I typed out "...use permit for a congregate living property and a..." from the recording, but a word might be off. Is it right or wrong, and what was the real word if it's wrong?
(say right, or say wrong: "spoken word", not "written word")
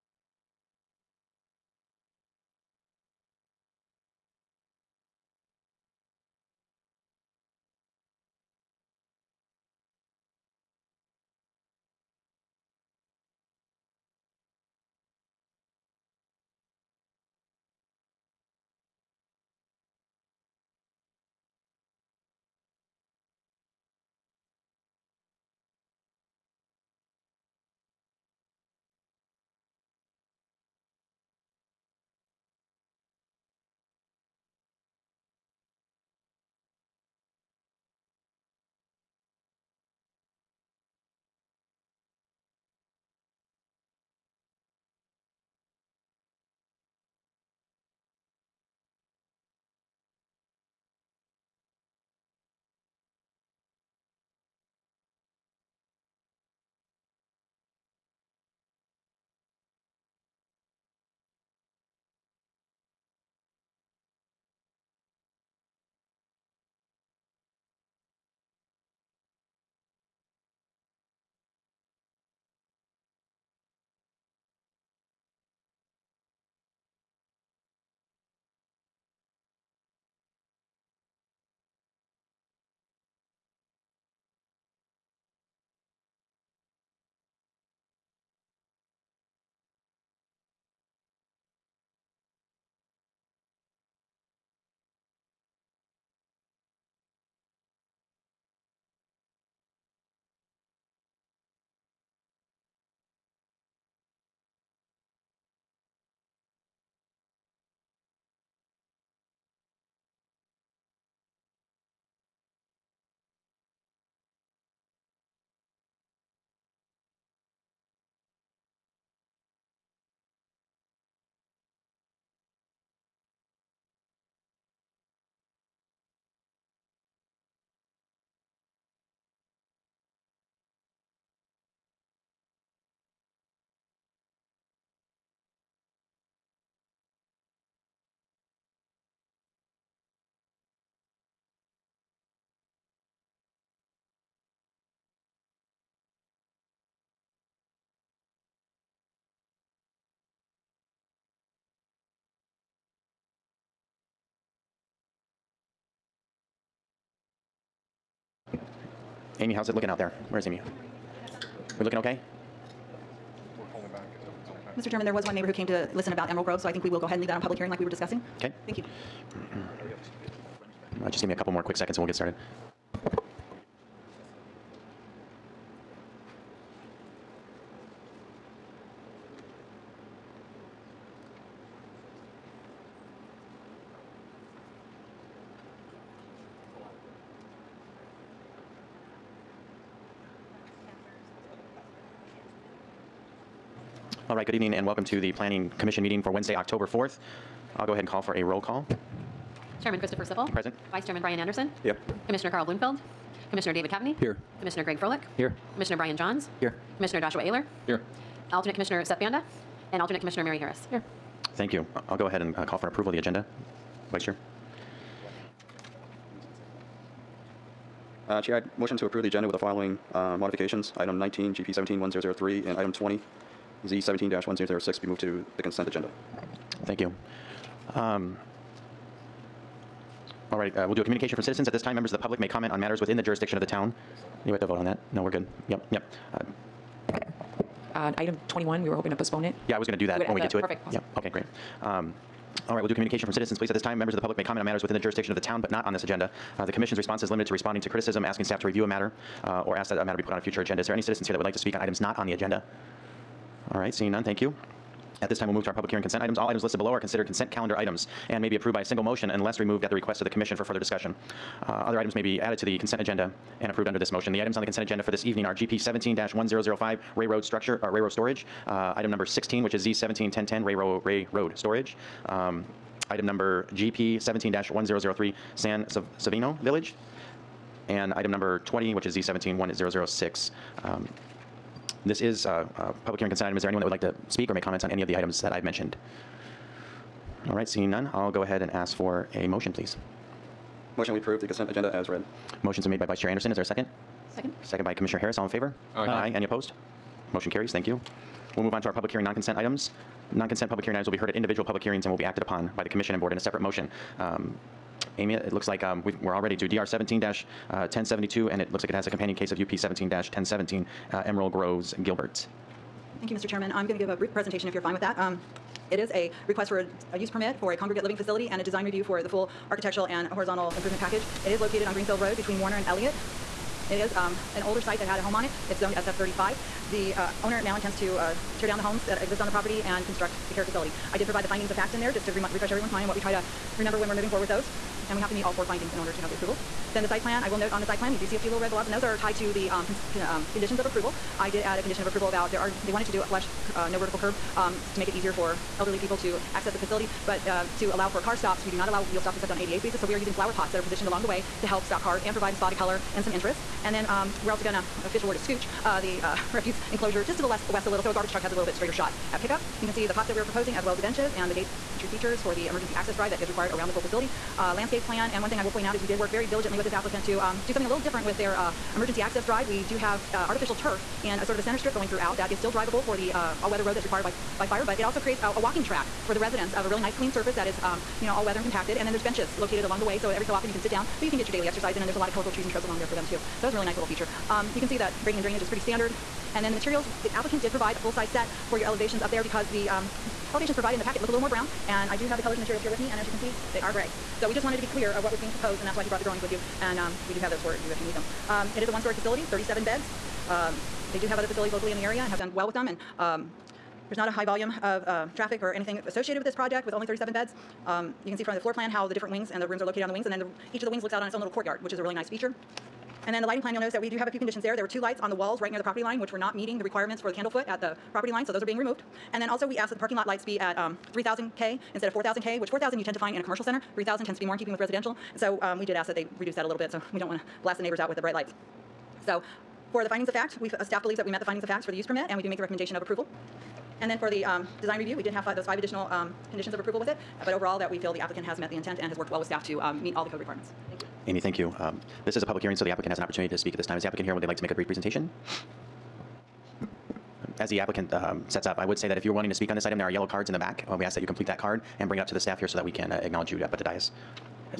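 wrong: "facility", not "property".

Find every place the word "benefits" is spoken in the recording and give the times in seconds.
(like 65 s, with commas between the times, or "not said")
not said.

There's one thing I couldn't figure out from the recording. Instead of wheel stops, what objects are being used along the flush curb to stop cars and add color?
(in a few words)
flower pots.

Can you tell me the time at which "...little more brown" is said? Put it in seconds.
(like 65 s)
391 s.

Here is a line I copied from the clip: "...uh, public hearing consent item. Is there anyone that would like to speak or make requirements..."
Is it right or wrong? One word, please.
wrong.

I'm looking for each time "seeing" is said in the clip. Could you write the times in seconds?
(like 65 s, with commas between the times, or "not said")
253 s, 287 s.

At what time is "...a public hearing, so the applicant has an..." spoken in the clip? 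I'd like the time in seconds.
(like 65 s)
442 s.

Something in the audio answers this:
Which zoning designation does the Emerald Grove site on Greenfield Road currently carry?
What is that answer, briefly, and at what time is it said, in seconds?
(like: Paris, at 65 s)
SF35, at 325 s.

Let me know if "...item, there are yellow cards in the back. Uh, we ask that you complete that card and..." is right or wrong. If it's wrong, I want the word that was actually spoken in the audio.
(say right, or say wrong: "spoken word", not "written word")
right.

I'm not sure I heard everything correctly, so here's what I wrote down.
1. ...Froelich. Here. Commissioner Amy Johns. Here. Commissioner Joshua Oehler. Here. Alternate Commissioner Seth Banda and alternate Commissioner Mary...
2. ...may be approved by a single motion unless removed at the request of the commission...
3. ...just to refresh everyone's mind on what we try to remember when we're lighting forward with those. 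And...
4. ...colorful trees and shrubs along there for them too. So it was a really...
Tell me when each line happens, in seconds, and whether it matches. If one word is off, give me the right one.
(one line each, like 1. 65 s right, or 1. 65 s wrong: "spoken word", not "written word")
1. 204 s wrong: "Brian", not "Amy"
2. 258 s right
3. 332 s wrong: "moving", not "lighting"
4. 382 s right.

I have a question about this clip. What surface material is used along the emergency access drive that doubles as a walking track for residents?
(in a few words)
artificial turf.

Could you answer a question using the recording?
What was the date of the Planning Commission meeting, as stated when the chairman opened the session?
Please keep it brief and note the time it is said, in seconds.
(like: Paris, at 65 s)
October 4th, at 196 s.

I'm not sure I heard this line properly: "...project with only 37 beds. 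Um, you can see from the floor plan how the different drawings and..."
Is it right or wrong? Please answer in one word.
wrong.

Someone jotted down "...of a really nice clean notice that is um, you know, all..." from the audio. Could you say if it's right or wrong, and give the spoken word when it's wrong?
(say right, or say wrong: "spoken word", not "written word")
wrong: "surface", not "notice".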